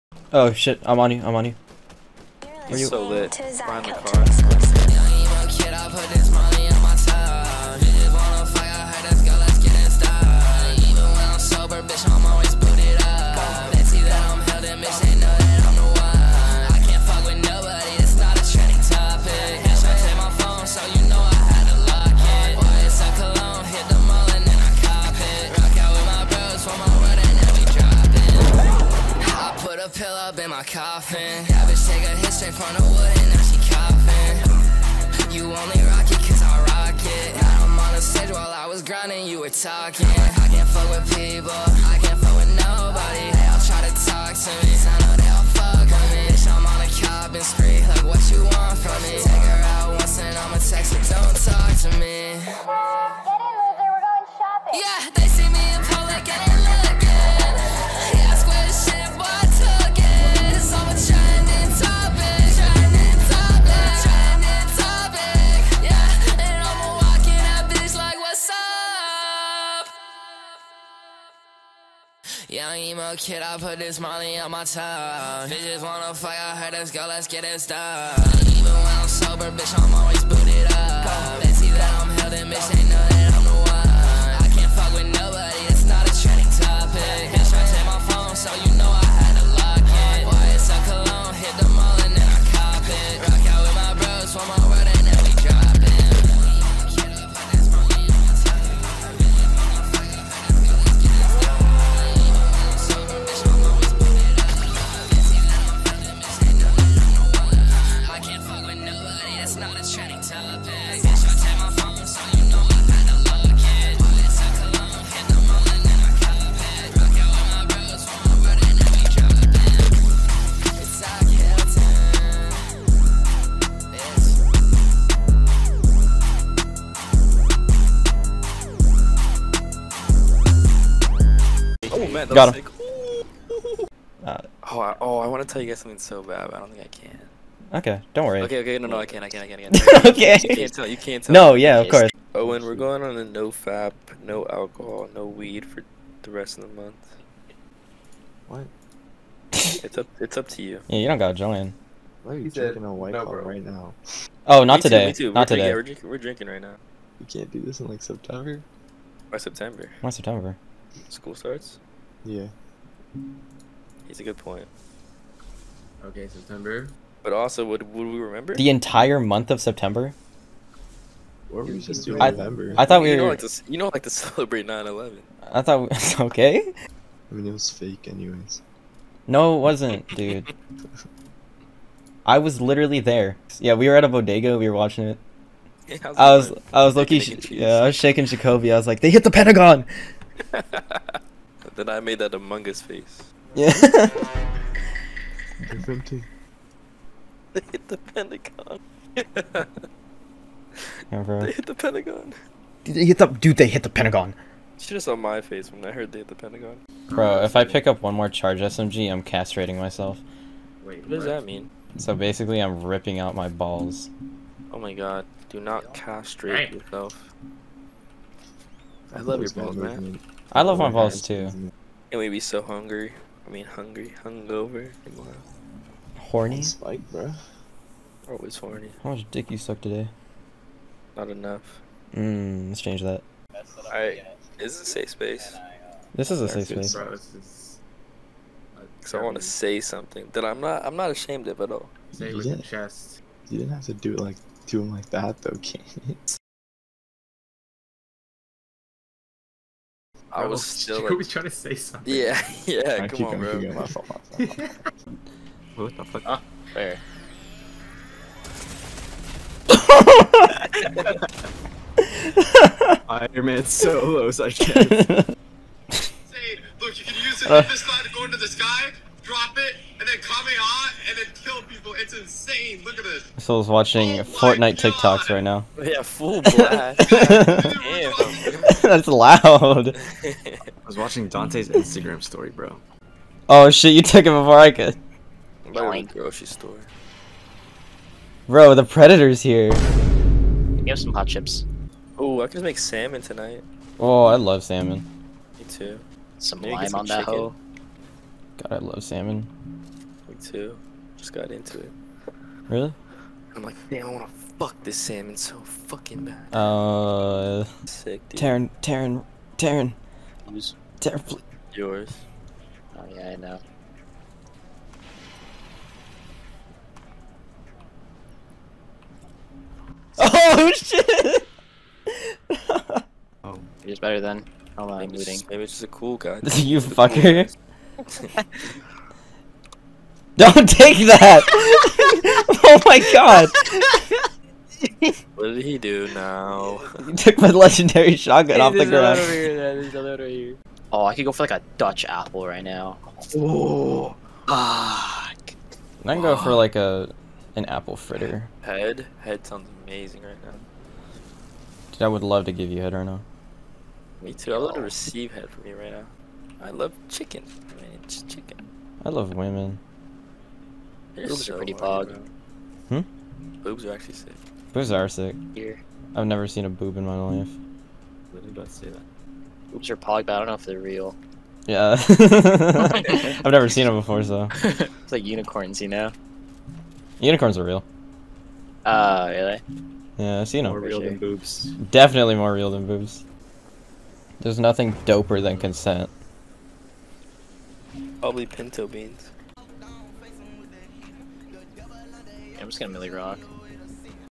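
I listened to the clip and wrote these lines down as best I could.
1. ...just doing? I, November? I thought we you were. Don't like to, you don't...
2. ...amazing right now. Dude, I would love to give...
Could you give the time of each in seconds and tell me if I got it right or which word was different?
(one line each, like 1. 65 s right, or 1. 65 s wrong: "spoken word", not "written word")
1. 171 s right
2. 349 s right.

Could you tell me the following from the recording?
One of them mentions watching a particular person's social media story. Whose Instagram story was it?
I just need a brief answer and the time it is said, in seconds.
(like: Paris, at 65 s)
Dante's, at 281 s.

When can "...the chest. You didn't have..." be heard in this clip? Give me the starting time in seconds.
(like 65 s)
242 s.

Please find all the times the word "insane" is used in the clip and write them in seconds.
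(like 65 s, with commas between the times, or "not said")
272 s.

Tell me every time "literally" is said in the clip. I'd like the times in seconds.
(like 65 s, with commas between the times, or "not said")
182 s, 368 s.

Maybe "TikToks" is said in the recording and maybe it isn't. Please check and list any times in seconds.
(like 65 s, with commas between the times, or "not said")
274 s.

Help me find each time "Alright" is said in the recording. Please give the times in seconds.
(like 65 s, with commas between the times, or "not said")
233 s.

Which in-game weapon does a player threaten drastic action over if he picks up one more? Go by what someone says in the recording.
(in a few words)
Charge SMG.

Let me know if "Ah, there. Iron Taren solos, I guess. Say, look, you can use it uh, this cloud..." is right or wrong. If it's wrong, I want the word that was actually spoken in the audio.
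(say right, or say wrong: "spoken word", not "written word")
wrong: "Man", not "Taren".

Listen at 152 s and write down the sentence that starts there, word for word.
Why are you He's drinking a white no, bro.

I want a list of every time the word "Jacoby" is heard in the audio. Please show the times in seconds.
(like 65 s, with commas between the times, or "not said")
188 s, 251 s.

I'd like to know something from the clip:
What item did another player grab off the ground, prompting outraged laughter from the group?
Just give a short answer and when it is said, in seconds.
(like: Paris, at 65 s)
Legendary shotgun, at 337 s.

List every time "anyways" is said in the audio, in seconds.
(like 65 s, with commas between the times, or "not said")
178 s.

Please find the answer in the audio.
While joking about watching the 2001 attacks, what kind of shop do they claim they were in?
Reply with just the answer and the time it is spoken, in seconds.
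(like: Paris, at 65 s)
A bodega, at 184 s.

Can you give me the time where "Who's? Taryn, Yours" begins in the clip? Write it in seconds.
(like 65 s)
310 s.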